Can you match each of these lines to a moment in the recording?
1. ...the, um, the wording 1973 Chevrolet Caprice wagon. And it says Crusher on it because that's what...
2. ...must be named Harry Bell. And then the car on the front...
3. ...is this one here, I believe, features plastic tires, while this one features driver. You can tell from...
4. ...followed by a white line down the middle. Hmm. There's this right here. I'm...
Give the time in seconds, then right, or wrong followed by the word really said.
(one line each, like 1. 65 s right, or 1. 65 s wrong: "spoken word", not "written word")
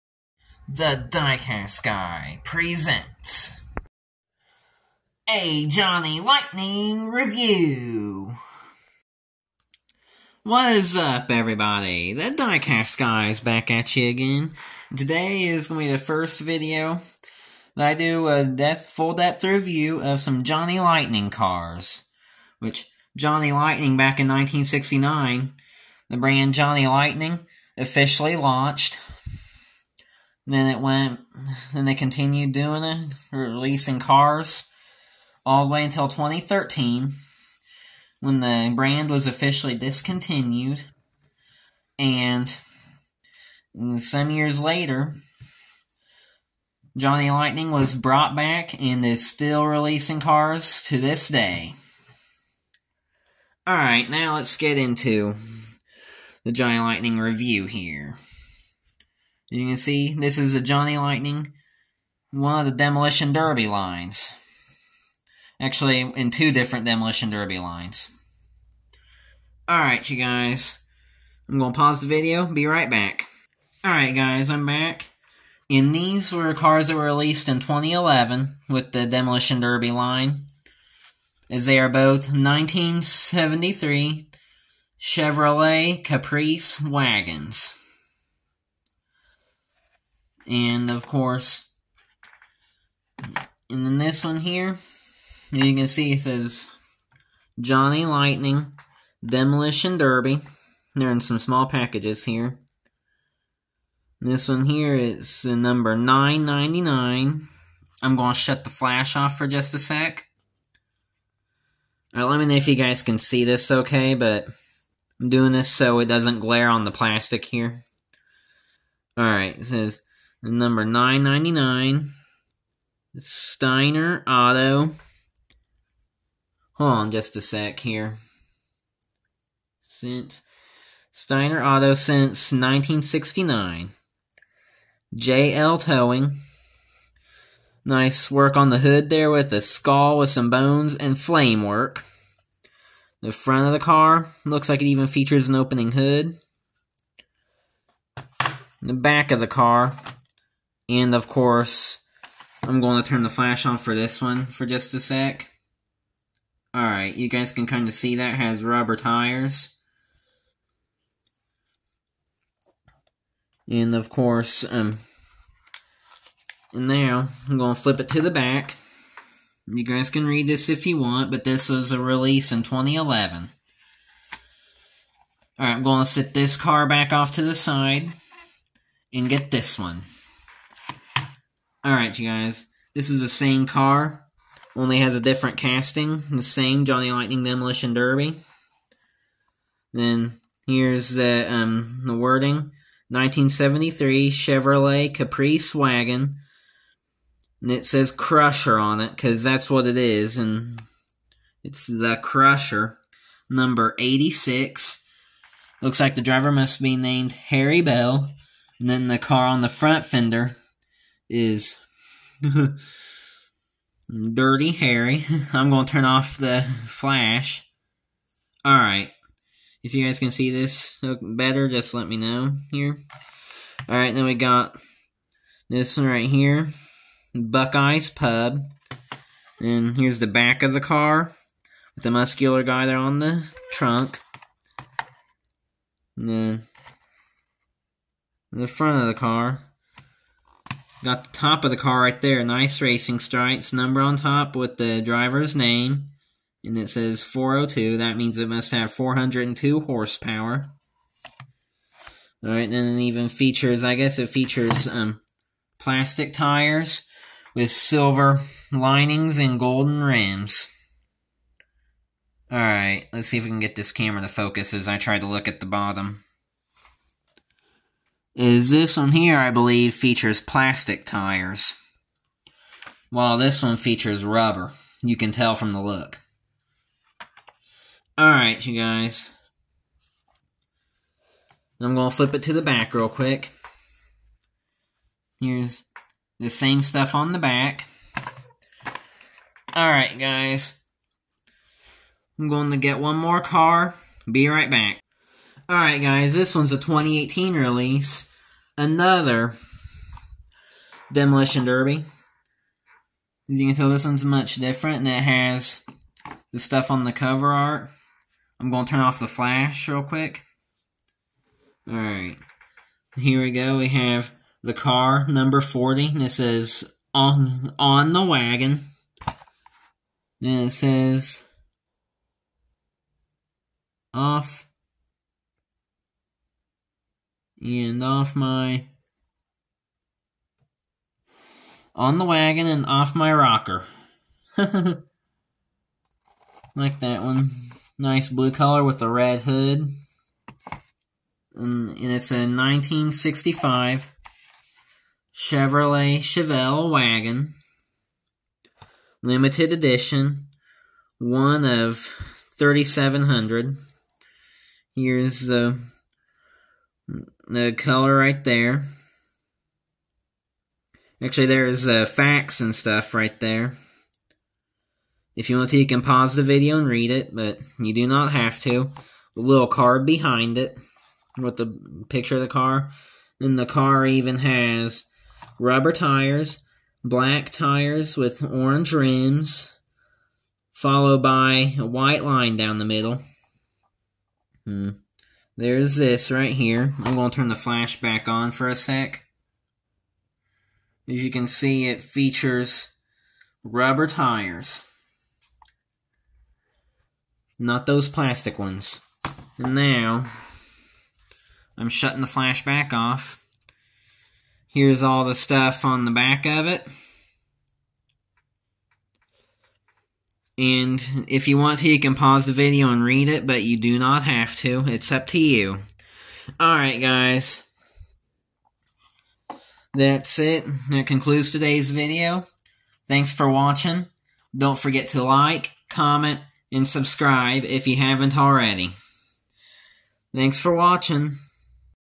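1. 191 s right
2. 206 s right
3. 268 s wrong: "rubber", not "driver"
4. 380 s right.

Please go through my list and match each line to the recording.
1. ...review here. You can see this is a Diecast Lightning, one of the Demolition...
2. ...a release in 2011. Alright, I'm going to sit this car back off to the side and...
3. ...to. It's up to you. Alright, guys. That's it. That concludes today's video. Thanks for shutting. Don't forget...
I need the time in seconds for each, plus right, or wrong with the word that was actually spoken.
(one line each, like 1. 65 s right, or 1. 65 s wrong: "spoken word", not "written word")
1. 57 s wrong: "Johnny", not "Diecast"
2. 171 s right
3. 414 s wrong: "watching", not "shutting".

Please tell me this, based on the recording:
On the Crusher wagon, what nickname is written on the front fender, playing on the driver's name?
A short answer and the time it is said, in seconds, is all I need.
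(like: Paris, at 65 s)
Dirty Harry, at 214 s.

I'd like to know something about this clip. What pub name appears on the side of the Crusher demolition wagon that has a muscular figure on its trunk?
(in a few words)
Buckeyes Pub.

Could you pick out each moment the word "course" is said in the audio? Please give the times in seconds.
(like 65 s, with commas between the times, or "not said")
91 s, 151 s, 164 s.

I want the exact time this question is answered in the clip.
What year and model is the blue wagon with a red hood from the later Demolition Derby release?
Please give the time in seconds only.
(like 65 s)
342 s.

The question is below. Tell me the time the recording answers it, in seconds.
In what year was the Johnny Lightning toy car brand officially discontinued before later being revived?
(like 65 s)
36 s.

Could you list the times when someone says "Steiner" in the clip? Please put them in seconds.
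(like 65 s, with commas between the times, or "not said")
123 s, 131 s.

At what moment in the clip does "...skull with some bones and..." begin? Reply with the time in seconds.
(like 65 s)
139 s.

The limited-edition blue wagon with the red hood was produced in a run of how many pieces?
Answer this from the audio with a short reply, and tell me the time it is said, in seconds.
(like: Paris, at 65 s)
3,700, at 352 s.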